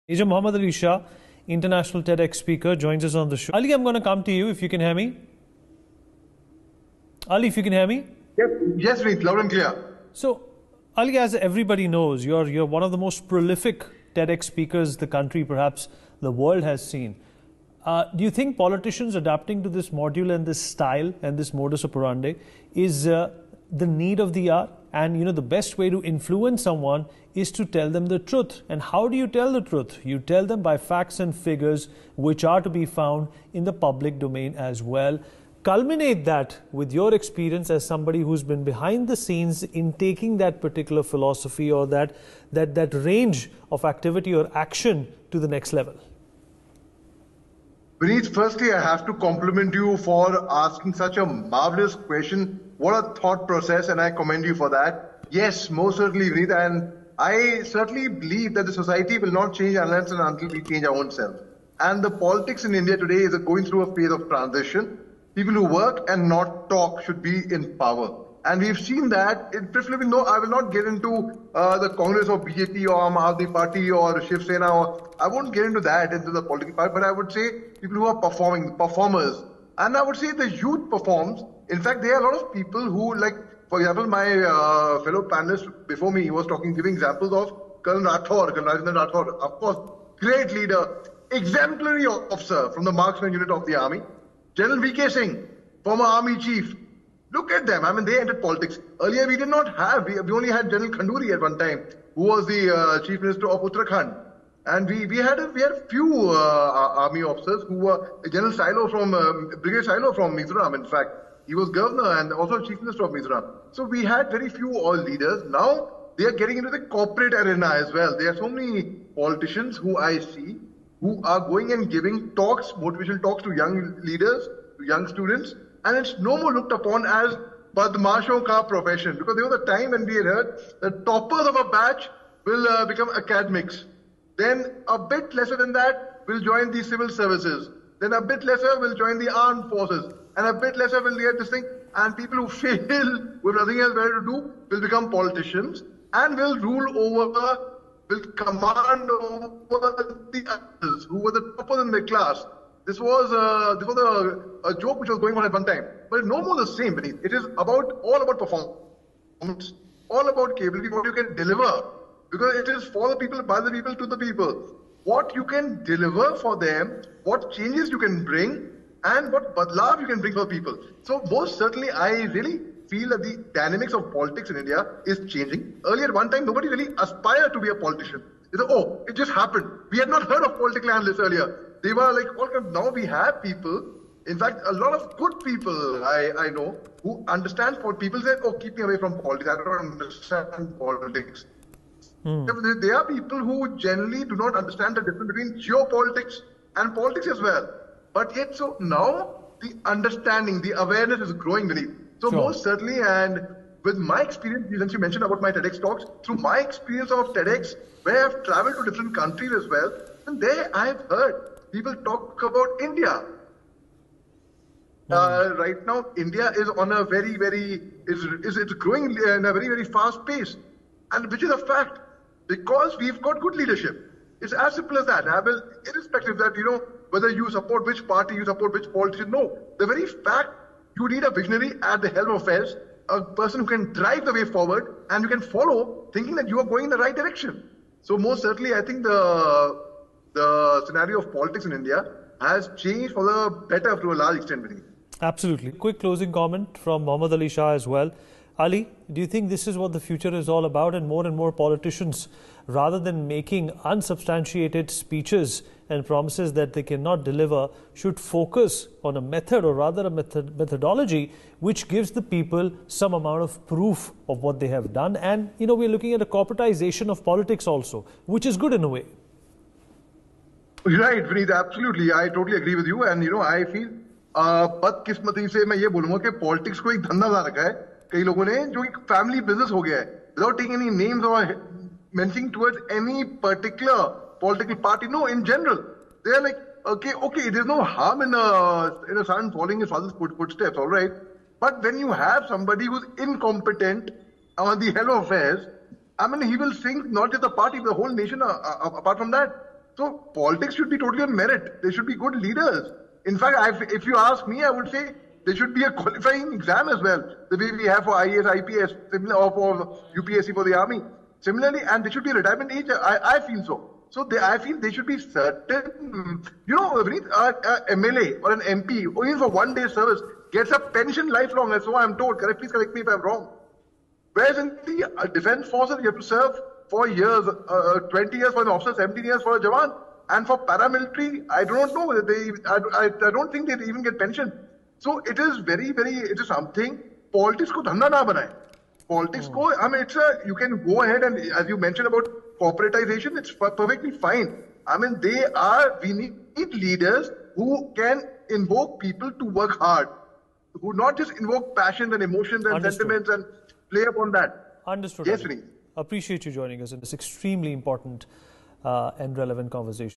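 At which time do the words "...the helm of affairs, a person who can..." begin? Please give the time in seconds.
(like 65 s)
232 s.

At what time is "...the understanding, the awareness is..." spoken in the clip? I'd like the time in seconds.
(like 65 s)
199 s.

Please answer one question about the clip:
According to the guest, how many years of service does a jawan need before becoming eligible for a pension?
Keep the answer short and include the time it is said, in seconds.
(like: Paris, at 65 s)
17 years, at 328 s.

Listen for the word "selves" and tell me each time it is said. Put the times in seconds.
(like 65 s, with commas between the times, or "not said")
61 s.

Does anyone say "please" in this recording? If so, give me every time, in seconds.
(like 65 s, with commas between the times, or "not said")
9 s, 322 s.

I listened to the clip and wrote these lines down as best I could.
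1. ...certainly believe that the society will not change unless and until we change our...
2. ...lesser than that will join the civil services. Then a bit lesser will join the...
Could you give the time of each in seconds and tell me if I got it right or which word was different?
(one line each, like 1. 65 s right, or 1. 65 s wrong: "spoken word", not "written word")
1. 57 s right
2. 135 s right.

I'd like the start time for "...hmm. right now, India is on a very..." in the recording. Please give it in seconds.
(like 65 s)
215 s.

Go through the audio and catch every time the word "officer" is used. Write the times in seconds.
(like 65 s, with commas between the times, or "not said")
92 s, 107 s, 328 s.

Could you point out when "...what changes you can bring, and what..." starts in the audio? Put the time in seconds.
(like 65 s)
167 s.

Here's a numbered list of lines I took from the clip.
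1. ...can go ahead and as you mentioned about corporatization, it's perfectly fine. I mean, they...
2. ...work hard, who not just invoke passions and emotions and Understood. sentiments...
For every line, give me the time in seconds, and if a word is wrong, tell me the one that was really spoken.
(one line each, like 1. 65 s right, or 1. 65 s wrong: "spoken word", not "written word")
1. 340 s right
2. 349 s right.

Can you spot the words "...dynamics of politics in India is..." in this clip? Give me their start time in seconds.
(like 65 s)
173 s.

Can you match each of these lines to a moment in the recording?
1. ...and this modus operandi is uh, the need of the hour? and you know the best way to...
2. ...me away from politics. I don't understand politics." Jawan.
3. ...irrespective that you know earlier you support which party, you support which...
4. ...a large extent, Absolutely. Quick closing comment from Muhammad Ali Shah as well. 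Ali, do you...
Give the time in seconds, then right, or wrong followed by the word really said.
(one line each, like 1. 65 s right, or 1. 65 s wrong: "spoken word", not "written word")
1. 21 s right
2. 188 s wrong: "Hmm", not "Jawan"
3. 225 s wrong: "whether", not "earlier"
4. 244 s right.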